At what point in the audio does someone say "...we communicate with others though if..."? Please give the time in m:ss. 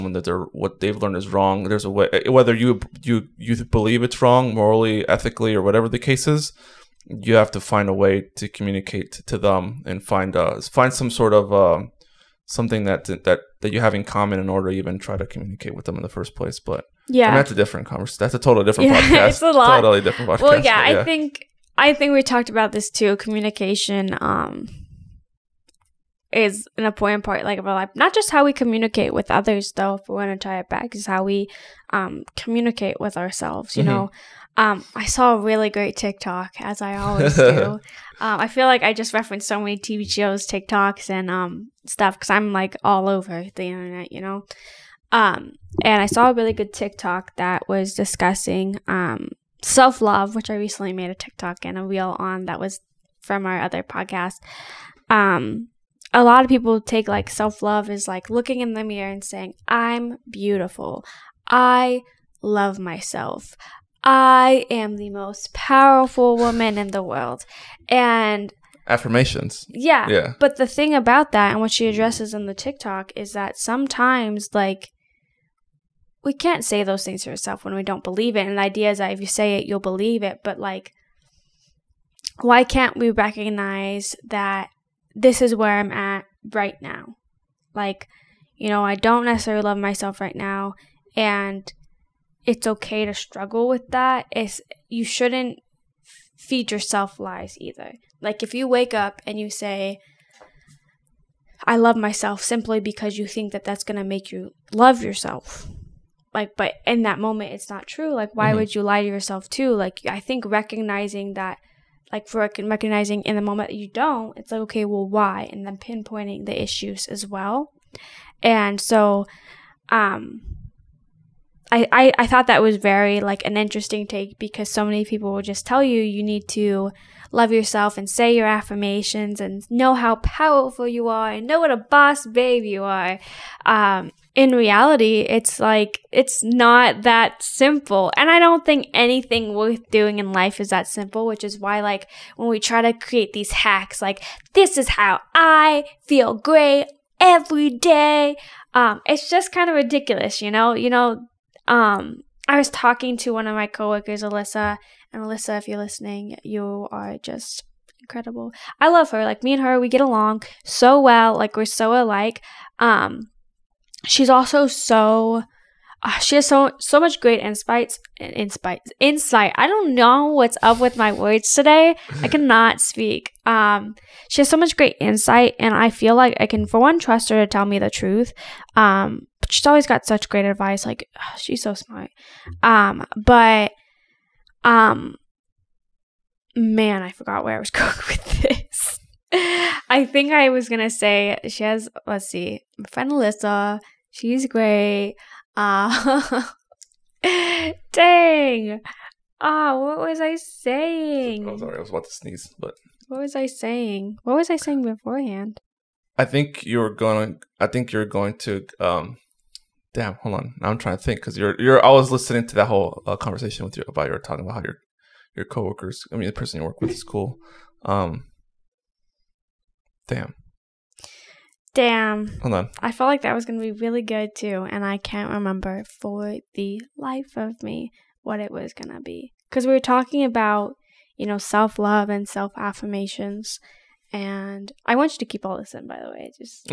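0:28.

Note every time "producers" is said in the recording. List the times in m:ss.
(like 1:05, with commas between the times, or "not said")
not said.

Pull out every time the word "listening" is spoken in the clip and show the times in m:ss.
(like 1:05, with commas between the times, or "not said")
2:35, 3:32.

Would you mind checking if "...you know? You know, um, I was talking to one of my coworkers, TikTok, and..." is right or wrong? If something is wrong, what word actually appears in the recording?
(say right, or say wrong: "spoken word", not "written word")
wrong: "Alyssa", not "TikTok".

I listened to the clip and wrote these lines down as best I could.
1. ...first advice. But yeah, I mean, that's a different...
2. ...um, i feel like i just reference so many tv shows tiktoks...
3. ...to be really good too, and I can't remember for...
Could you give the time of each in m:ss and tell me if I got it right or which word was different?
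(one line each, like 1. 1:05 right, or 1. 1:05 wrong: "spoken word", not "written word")
1. 0:16 wrong: "place", not "advice"
2. 0:38 right
3. 3:43 right.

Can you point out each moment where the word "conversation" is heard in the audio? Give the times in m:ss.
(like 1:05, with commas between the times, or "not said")
0:17, 3:33.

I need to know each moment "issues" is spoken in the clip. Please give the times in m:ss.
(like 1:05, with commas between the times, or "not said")
1:56.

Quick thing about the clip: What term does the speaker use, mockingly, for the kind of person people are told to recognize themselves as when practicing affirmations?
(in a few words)
boss babe.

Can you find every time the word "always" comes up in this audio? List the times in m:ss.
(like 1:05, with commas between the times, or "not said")
0:36, 2:59.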